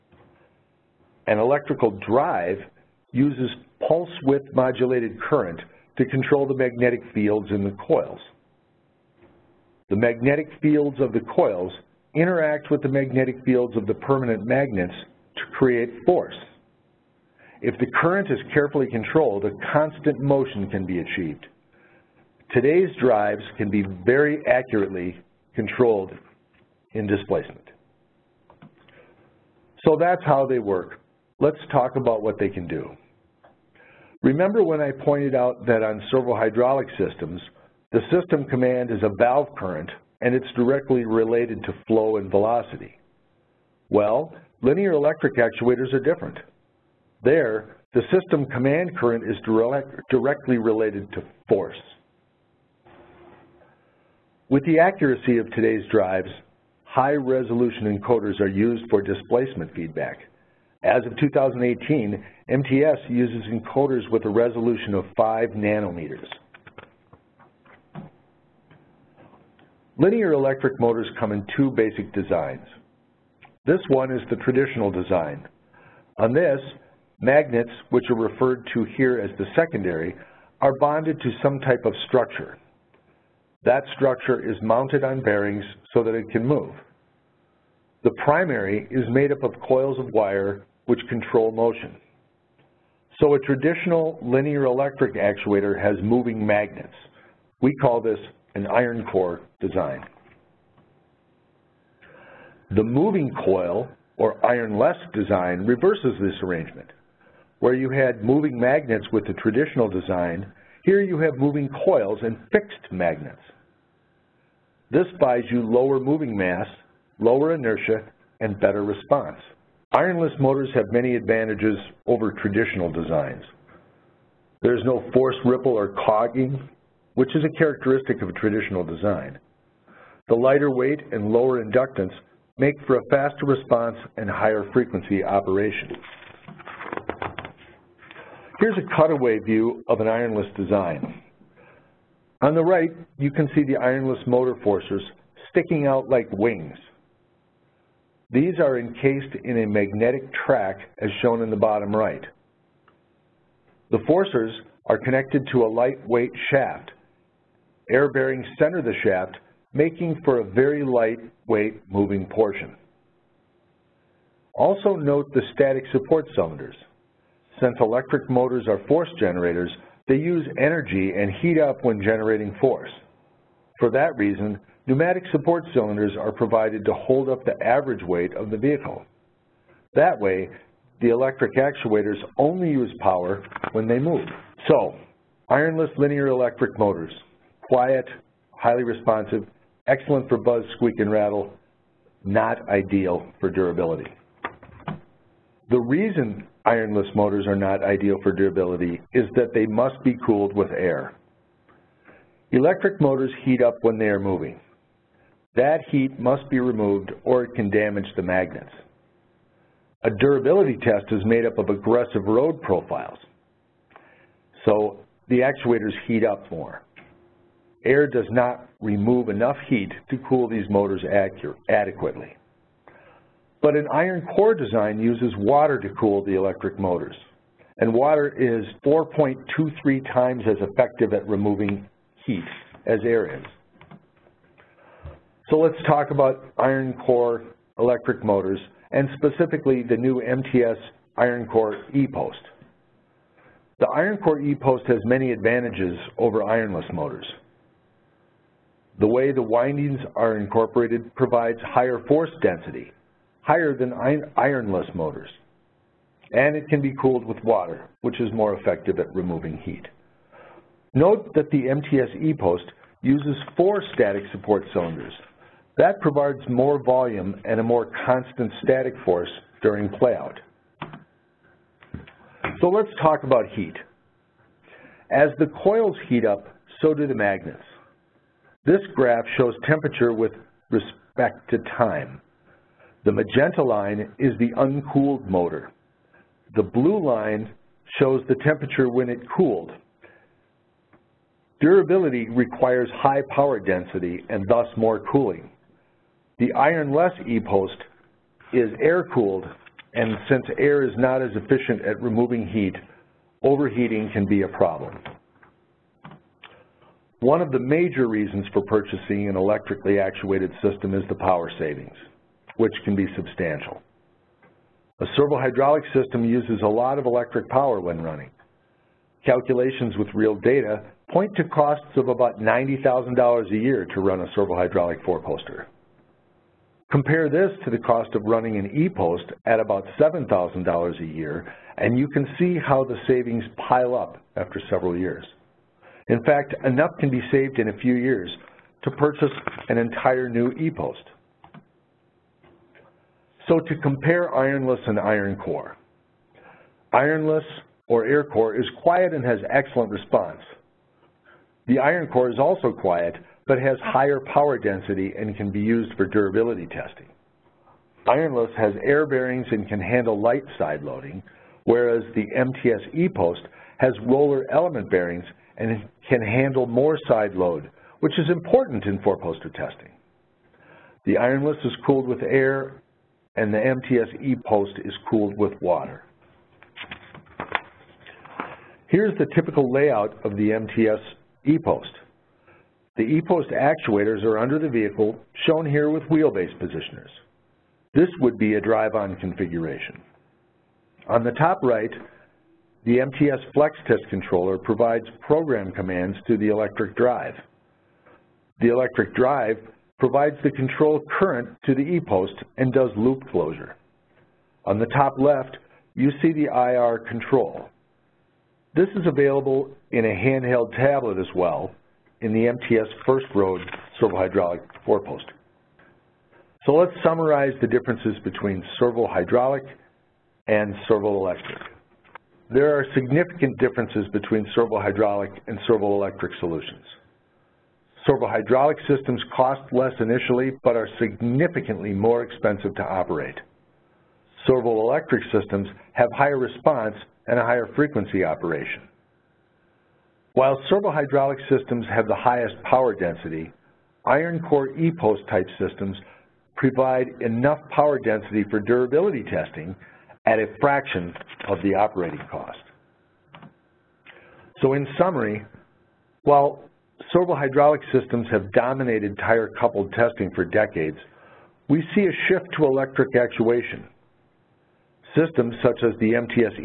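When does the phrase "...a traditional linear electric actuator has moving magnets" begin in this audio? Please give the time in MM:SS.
01:33.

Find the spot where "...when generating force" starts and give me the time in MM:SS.
02:51.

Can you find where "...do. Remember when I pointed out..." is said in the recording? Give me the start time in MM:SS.
00:32.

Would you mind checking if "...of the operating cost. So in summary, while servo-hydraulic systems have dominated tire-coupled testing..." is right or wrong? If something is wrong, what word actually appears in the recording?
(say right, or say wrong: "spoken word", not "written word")
right.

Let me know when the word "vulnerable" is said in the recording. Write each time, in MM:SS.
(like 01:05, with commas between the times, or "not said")
not said.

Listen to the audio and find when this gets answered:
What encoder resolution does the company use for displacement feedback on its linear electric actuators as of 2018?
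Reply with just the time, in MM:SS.
01:05.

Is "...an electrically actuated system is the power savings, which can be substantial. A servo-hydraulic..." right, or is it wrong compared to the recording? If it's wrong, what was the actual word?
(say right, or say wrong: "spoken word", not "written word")
right.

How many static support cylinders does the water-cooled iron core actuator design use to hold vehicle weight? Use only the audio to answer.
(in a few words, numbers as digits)
4.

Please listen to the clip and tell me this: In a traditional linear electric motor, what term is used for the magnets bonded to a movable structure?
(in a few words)
the secondary.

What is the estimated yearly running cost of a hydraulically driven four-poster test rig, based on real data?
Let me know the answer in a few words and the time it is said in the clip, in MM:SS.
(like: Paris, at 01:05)
$90,000, at 05:22.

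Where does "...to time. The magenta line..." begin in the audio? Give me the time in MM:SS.
04:41.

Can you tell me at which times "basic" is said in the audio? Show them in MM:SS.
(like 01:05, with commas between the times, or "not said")
01:11.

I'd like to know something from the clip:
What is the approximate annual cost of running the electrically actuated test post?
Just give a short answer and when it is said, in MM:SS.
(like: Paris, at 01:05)
$7,000, at 05:29.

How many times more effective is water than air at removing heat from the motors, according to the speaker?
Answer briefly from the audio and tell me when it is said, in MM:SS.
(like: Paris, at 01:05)
4.23, at 03:48.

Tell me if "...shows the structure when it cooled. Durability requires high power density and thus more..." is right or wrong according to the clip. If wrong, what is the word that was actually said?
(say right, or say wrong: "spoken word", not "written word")
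wrong: "temperature", not "structure".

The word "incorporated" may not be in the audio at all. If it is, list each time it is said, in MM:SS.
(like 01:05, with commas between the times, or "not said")
04:10.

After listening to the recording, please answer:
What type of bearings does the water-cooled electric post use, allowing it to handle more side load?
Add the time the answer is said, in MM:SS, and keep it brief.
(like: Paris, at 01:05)
roller element bearings, at 06:04.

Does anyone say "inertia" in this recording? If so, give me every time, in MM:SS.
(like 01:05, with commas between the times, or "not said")
01:57.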